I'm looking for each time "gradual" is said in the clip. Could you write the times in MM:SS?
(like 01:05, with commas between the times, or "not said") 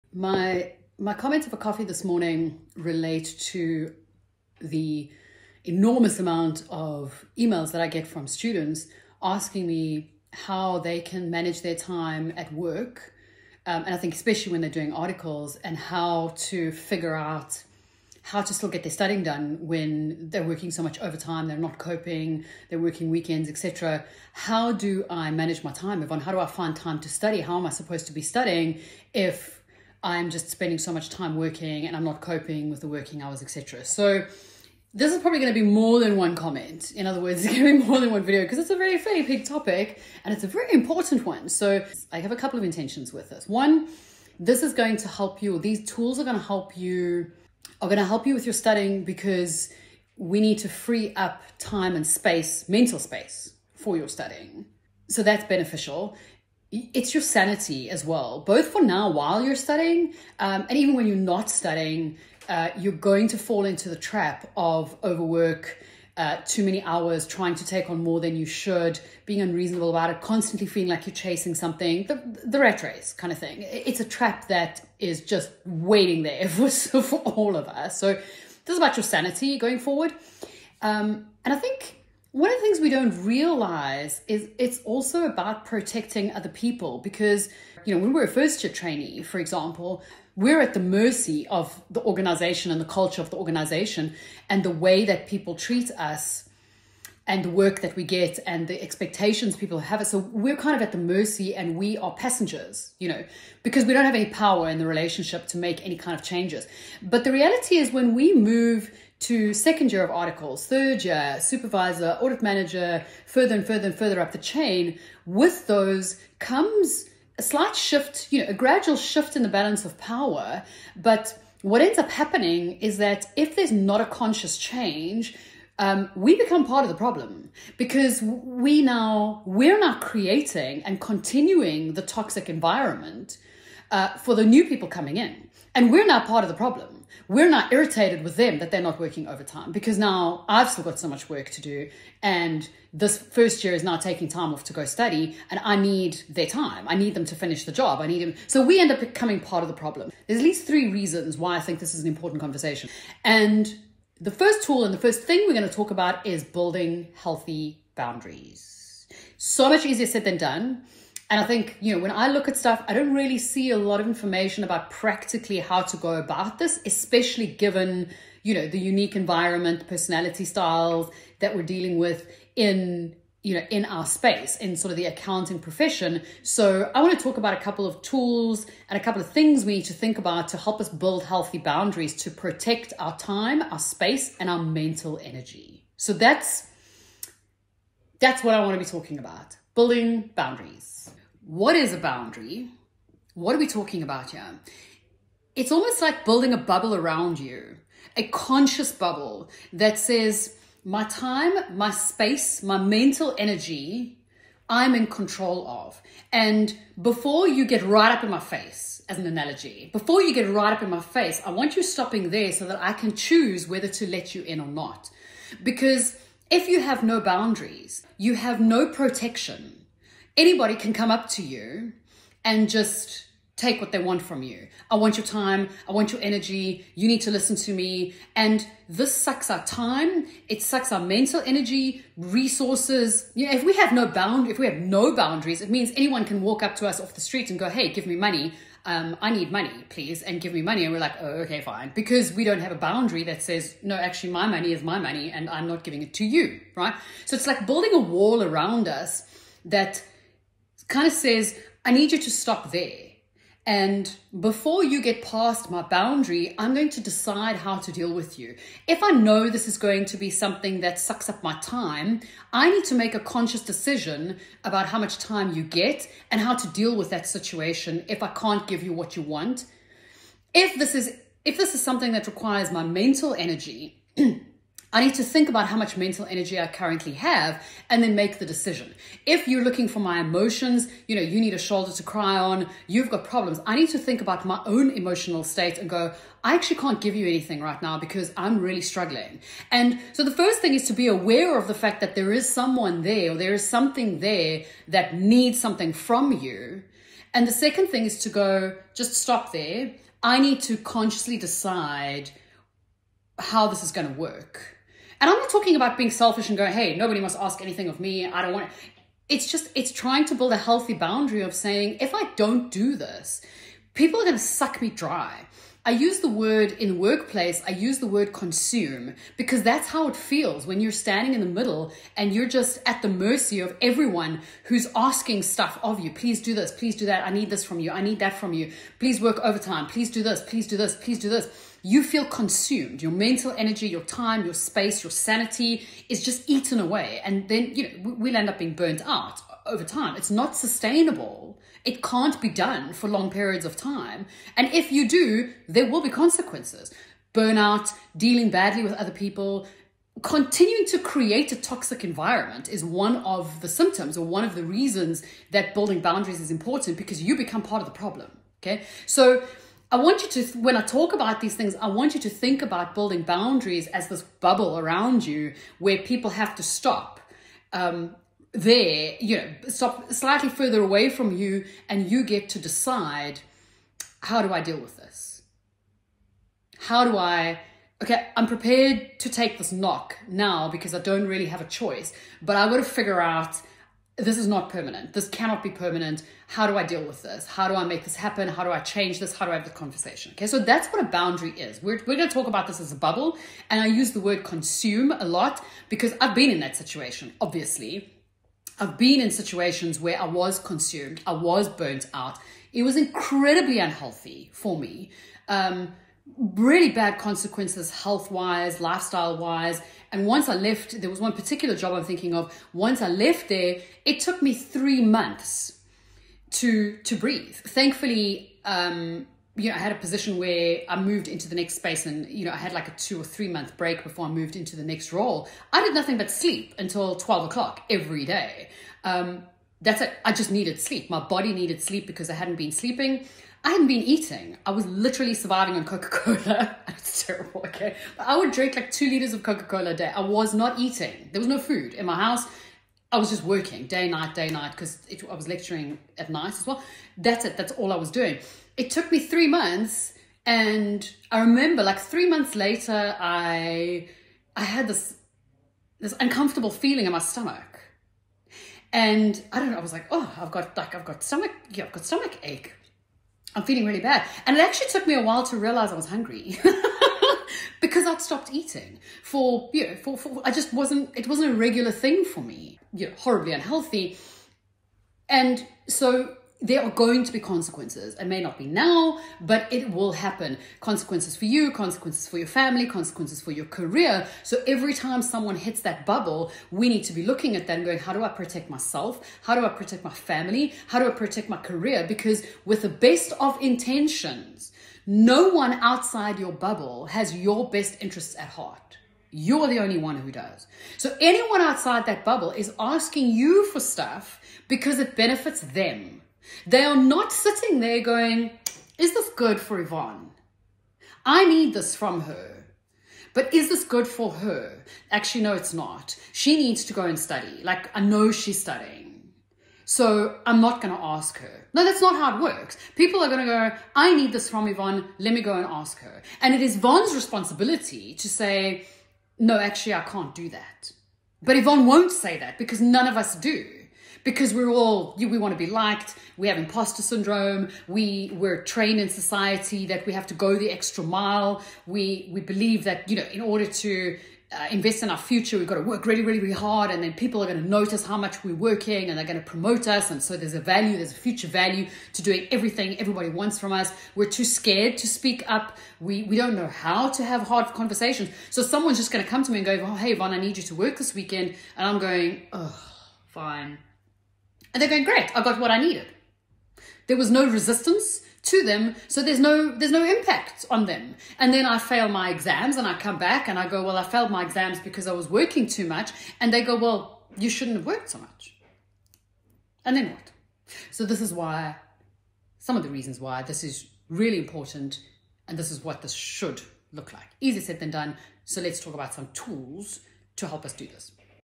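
01:58.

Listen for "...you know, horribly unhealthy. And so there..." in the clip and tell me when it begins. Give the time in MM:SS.
07:52.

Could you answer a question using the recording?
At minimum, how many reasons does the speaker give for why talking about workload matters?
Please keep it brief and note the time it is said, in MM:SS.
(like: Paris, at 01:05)
at least 3, at 02:30.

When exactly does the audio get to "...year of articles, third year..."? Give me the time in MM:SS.
01:49.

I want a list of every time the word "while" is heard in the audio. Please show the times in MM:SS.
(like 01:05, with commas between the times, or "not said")
00:59, 07:45.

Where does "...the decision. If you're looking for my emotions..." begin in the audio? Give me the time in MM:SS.
04:38.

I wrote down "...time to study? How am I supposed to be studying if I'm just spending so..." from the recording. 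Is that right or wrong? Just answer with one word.
right.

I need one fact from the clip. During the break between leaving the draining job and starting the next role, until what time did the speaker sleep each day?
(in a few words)
12 o'clock.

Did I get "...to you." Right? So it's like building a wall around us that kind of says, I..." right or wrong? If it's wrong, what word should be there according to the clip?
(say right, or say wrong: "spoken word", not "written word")
right.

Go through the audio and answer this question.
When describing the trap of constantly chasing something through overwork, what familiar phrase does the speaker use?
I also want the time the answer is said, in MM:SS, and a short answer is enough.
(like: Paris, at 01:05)
the rat race, at 01:12.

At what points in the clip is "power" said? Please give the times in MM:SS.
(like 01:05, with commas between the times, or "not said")
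01:44, 01:59.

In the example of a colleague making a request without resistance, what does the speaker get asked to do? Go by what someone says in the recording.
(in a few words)
work this weekend.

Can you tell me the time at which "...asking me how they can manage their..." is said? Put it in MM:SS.
00:09.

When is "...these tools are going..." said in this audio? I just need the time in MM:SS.
00:45.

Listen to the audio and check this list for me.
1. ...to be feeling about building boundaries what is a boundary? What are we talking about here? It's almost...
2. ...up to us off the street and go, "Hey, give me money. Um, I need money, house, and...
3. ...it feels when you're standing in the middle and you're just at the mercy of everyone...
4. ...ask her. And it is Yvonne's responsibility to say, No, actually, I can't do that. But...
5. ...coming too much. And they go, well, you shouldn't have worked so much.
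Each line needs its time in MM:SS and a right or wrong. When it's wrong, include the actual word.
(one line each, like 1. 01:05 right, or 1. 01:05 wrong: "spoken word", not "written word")
1. 03:08 wrong: "talking", not "feeling"
2. 03:56 wrong: "please", not "house"
3. 05:20 right
4. 08:45 right
5. 09:35 wrong: "working", not "coming".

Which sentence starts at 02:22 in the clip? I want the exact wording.
And this first year is now taking time off to go study, and I need their time.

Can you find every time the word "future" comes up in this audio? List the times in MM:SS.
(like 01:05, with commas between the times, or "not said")
09:05, 09:11.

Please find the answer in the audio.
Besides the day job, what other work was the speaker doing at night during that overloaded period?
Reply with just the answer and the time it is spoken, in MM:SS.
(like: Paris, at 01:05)
lecturing, at 07:25.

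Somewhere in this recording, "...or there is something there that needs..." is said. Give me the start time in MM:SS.
04:53.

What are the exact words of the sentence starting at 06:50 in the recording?
And once I left, there was one particular job I'm thinking of.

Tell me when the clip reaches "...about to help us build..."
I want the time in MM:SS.
03:00.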